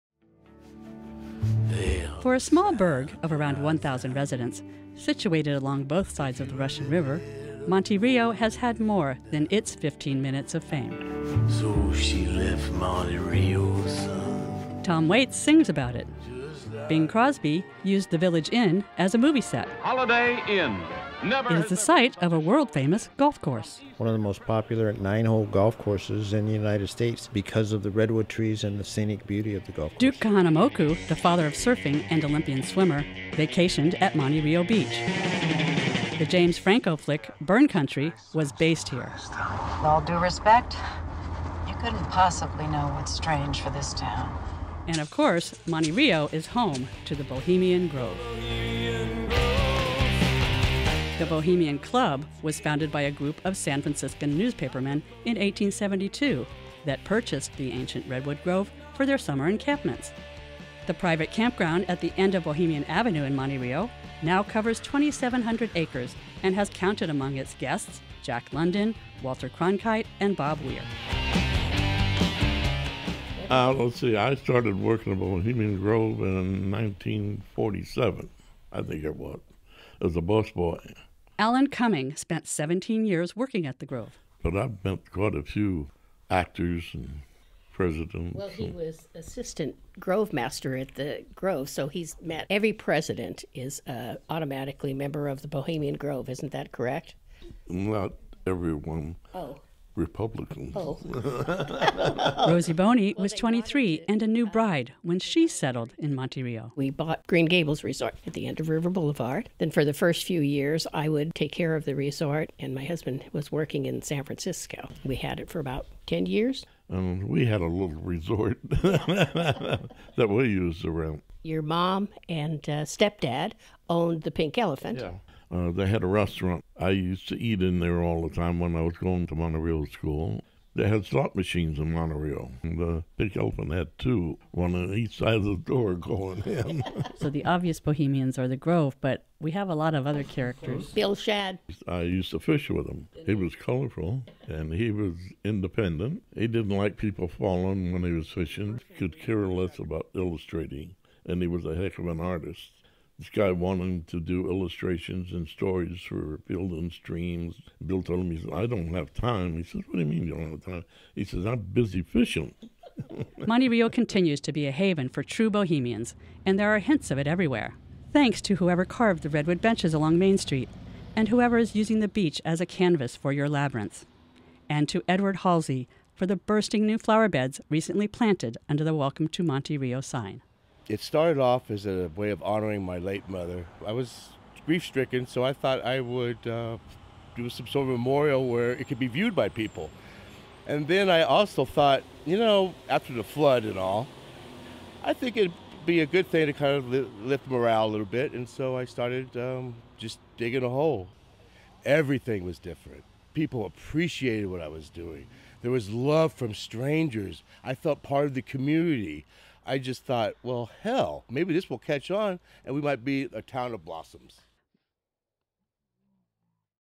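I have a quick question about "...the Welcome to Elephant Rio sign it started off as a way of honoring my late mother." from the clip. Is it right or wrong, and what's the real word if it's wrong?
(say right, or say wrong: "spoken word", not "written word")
wrong: "Monte", not "Elephant".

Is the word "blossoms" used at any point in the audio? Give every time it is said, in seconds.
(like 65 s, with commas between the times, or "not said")
213 s.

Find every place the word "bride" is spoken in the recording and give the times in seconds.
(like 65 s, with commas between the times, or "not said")
104 s.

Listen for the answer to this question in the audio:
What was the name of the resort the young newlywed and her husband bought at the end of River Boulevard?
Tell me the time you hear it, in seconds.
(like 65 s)
107 s.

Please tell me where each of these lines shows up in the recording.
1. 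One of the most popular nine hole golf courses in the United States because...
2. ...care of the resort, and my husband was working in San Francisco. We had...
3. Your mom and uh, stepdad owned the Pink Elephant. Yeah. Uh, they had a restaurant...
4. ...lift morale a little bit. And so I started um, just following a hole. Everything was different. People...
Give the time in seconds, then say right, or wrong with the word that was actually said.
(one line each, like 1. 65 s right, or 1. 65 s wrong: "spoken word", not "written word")
1. 23 s right
2. 111 s right
3. 121 s right
4. 197 s wrong: "digging", not "following".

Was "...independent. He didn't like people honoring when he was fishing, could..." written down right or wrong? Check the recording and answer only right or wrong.
wrong.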